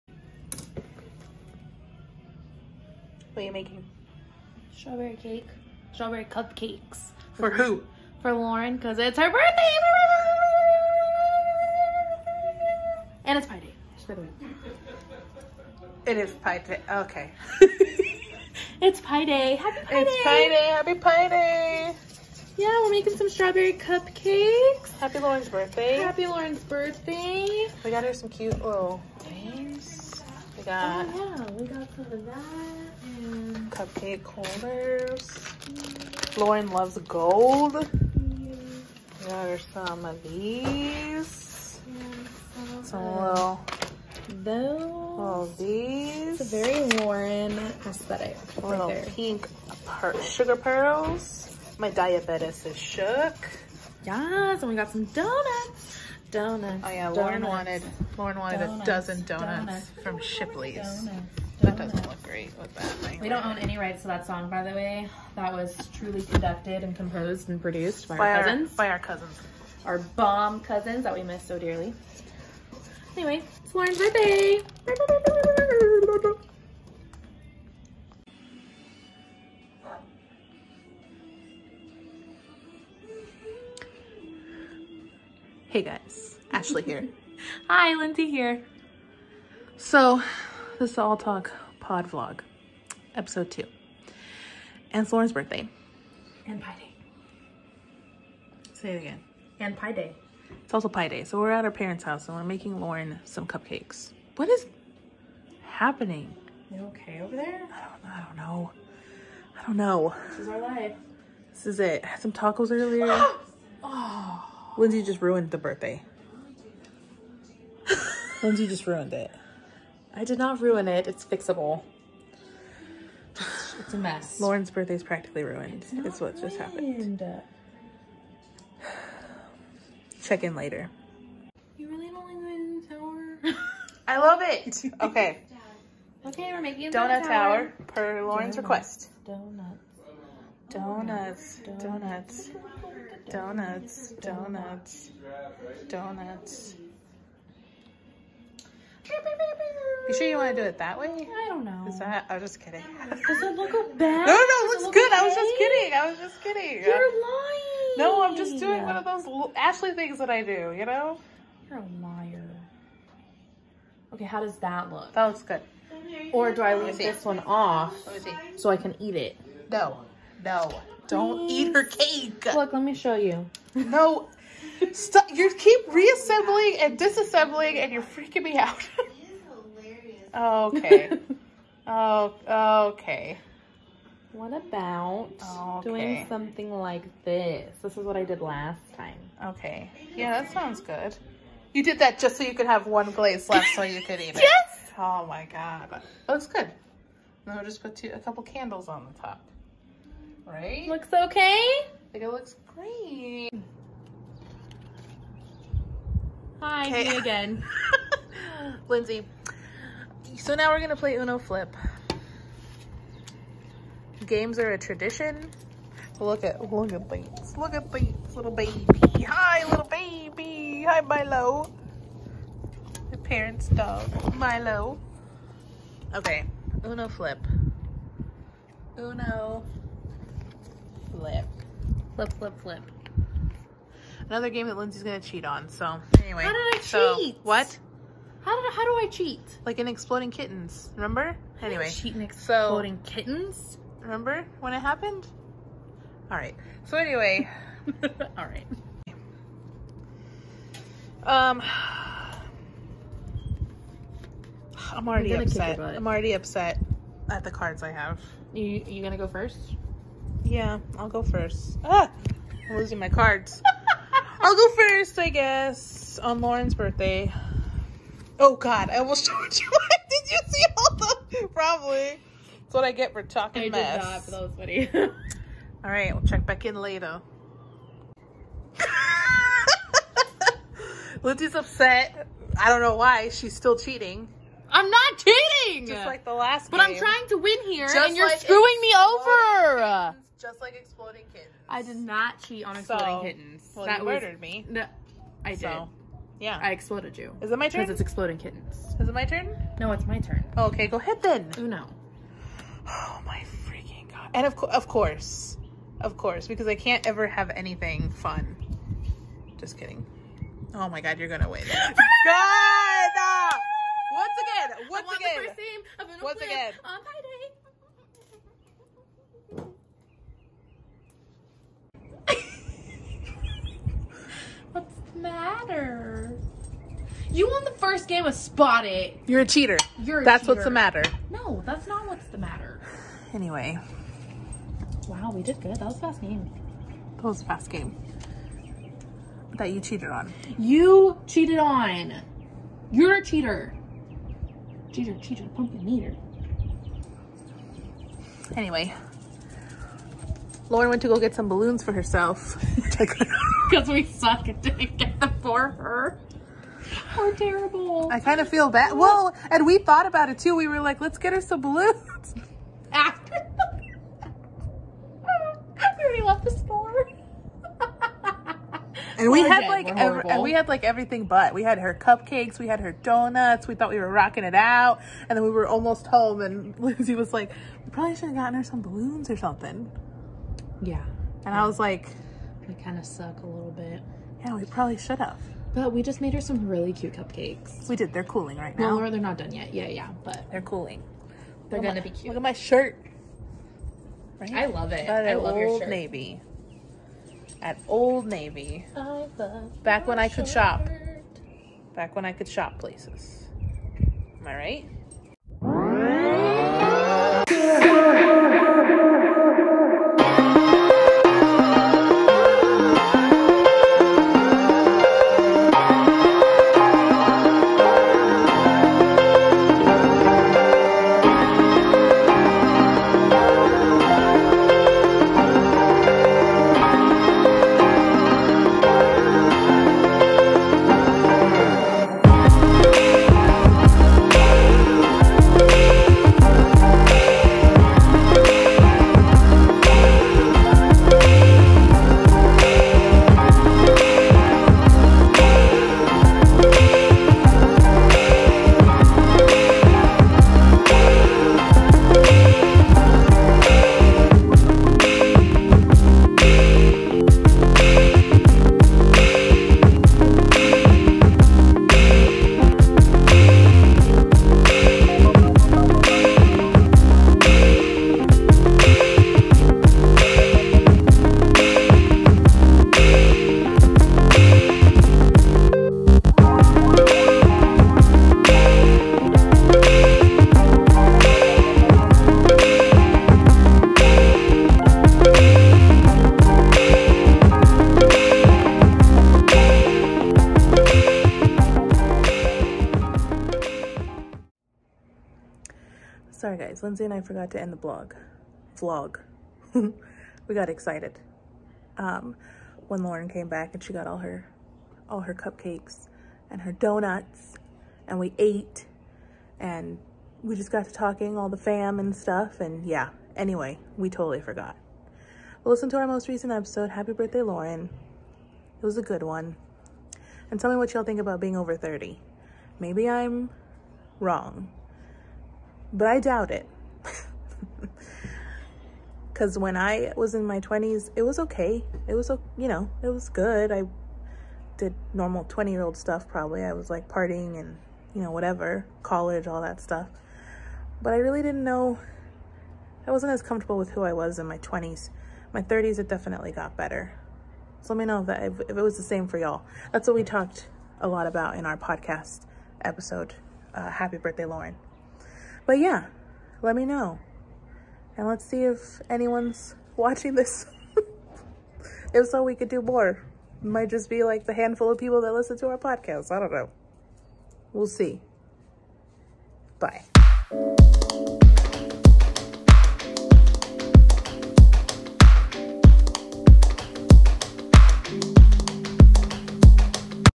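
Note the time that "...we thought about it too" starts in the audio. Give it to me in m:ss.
5:59.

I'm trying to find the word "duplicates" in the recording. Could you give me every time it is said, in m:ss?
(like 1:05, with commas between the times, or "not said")
not said.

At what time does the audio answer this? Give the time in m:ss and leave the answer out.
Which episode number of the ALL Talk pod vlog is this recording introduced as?
1:33.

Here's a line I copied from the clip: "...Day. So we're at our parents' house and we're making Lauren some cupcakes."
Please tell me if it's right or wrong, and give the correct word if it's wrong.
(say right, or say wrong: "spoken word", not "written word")
right.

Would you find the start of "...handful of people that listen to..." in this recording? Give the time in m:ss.
9:24.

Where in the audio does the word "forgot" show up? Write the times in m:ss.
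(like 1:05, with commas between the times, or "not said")
8:17, 8:34.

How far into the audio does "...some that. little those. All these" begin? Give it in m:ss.
0:42.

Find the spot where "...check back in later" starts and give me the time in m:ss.
4:36.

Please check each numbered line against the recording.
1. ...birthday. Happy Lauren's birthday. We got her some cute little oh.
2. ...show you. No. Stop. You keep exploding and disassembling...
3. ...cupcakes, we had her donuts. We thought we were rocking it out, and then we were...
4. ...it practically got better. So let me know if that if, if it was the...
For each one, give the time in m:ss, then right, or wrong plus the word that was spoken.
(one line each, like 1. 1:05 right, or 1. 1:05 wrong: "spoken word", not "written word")
1. 0:25 right
2. 2:52 wrong: "reassembling", not "exploding"
3. 6:11 right
4. 9:05 wrong: "definitely", not "practically".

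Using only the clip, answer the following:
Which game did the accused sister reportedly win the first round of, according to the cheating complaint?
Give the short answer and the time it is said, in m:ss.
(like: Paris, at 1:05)
Spot It, at 5:28.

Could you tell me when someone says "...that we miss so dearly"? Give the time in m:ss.
1:11.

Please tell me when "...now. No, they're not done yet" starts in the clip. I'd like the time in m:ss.
6:28.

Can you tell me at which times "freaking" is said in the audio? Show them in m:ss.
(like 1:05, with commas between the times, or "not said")
2:58, 5:03.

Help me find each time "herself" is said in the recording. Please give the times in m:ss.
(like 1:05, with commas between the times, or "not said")
5:51.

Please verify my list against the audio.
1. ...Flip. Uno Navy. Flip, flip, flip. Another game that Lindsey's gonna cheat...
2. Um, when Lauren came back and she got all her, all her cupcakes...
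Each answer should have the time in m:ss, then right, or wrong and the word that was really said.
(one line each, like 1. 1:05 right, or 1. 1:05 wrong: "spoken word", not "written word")
1. 3:47 wrong: "Flip", not "Navy"
2. 8:21 right.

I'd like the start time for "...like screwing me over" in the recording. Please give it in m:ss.
4:48.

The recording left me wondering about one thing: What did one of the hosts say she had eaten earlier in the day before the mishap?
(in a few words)
Tacos.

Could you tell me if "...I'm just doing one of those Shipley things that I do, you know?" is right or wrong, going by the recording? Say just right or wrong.
wrong.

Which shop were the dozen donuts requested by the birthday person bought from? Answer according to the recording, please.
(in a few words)
Shipley's.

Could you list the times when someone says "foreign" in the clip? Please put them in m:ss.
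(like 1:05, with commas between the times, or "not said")
not said.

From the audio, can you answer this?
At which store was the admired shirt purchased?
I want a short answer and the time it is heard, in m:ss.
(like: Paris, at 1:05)
Old Navy, at 6:37.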